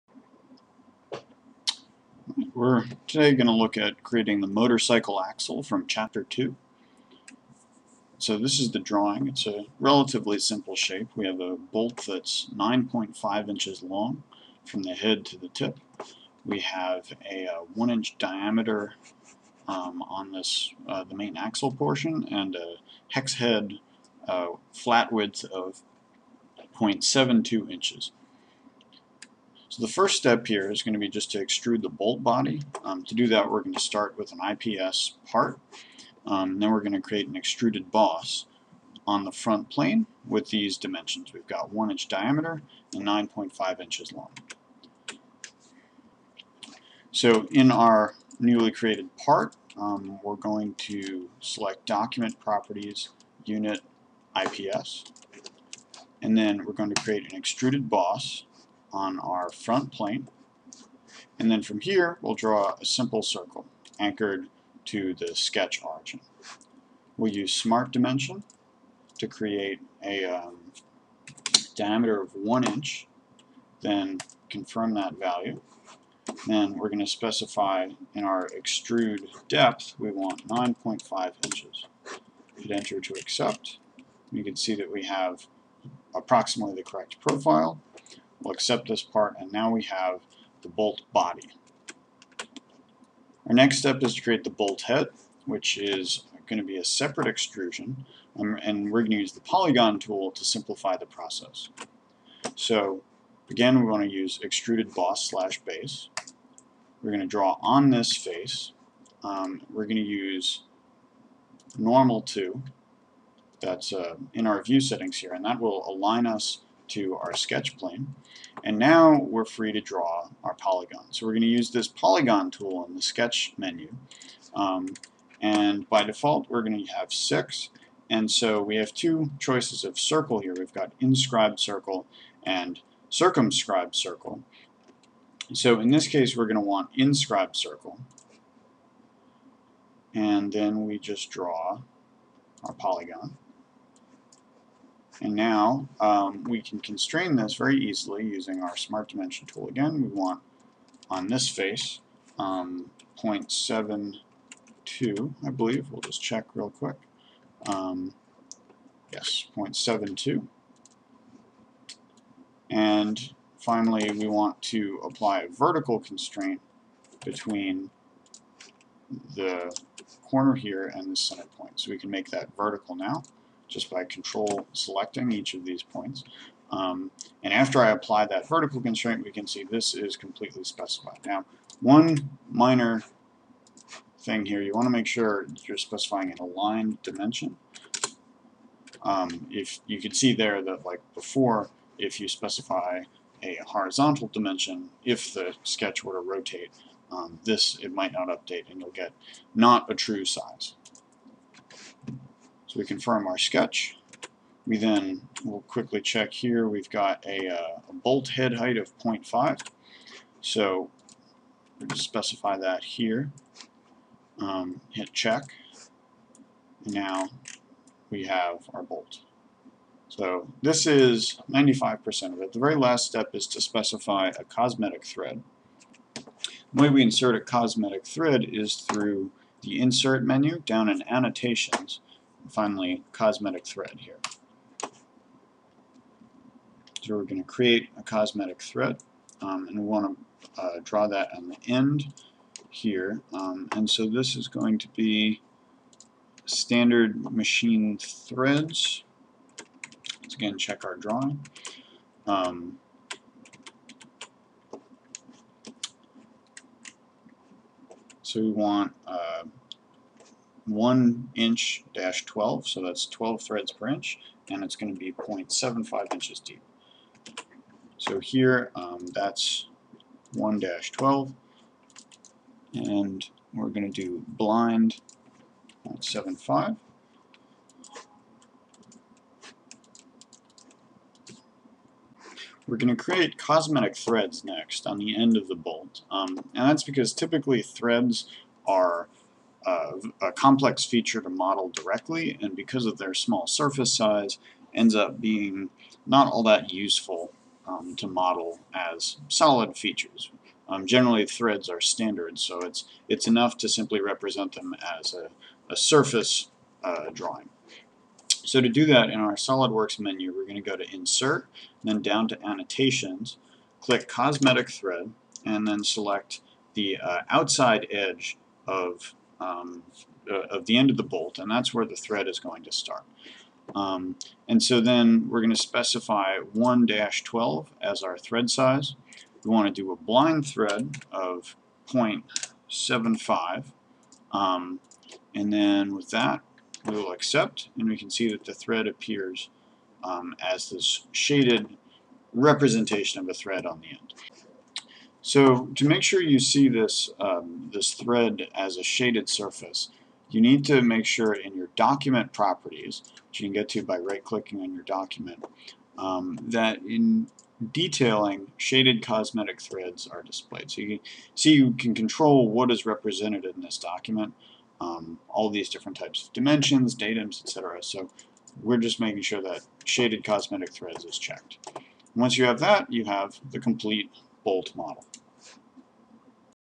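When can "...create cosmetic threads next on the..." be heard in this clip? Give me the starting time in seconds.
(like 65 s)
282 s.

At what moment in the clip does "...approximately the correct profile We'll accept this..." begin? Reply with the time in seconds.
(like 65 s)
86 s.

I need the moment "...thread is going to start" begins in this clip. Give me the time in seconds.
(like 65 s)
321 s.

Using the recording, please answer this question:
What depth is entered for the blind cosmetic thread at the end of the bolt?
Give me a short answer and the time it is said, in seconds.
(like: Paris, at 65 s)
0.75 inches, at 265 s.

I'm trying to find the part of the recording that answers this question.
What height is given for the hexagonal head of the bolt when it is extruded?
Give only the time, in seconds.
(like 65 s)
207 s.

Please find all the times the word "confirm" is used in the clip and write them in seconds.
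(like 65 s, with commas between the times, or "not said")
74 s, 202 s.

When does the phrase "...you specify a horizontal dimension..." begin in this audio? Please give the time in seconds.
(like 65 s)
192 s.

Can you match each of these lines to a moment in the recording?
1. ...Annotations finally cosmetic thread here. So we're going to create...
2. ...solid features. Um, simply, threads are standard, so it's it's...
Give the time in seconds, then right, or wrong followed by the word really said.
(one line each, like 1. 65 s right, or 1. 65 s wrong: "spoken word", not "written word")
1. 231 s right
2. 299 s wrong: "generally", not "simply".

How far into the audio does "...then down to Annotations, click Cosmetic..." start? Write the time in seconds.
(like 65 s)
311 s.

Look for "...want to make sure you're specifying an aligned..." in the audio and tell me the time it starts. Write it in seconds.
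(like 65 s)
184 s.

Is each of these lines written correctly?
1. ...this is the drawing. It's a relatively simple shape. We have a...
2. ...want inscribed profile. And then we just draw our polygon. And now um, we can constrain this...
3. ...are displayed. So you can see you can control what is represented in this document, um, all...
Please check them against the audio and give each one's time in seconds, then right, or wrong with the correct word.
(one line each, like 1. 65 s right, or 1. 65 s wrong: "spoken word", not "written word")
1. 8 s right
2. 136 s wrong: "circle", not "profile"
3. 360 s right.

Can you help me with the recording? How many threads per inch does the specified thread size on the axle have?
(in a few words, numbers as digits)
12.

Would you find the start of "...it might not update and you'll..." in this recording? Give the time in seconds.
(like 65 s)
197 s.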